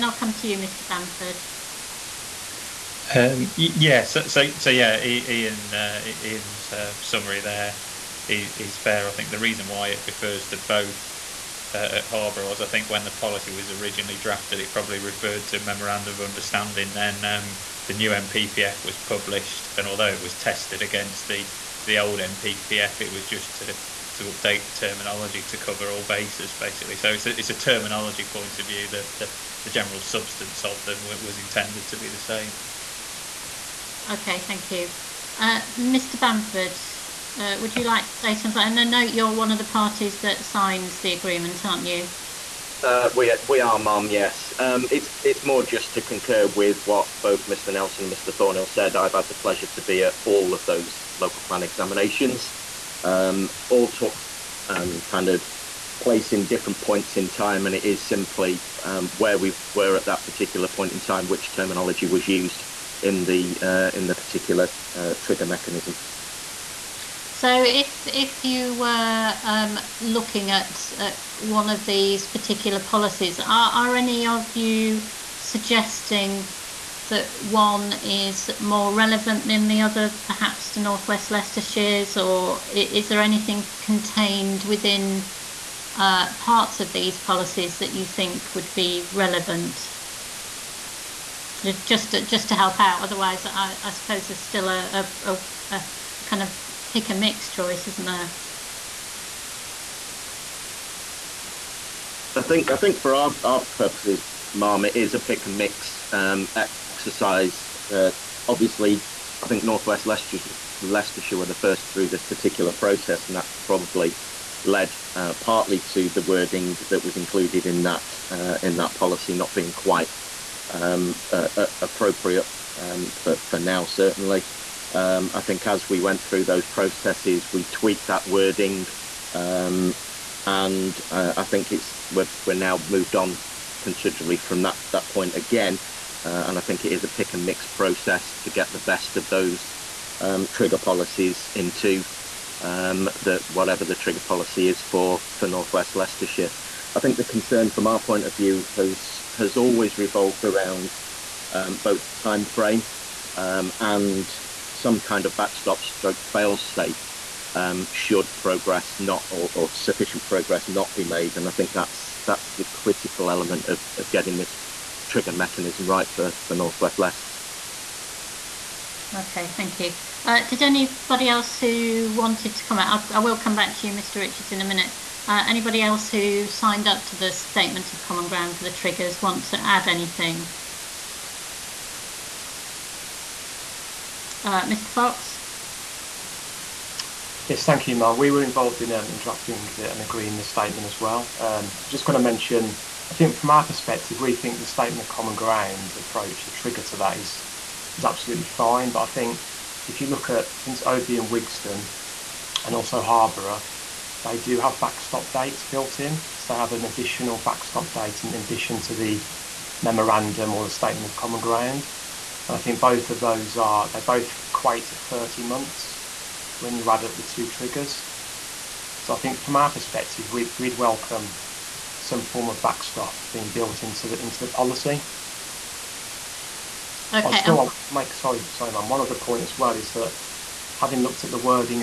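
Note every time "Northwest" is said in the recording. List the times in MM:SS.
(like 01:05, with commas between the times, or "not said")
01:20, 01:49, 02:25, 02:46.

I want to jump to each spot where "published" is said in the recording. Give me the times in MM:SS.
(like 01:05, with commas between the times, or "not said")
00:18.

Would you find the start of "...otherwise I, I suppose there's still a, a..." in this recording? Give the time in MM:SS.
01:33.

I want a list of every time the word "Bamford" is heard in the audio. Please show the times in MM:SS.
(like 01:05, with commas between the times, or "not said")
00:00, 00:36.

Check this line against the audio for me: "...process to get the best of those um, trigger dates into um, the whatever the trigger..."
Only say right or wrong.
wrong.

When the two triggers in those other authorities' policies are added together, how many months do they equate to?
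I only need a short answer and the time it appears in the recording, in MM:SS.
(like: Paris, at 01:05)
30 months, at 03:34.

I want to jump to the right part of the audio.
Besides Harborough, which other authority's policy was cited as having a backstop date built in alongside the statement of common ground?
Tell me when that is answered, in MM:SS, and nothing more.
03:20.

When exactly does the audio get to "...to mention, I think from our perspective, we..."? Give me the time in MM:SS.
03:12.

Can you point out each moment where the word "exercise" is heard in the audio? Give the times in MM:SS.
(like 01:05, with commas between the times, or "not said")
01:46.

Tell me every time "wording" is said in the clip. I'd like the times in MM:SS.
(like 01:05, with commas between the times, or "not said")
01:56, 02:08.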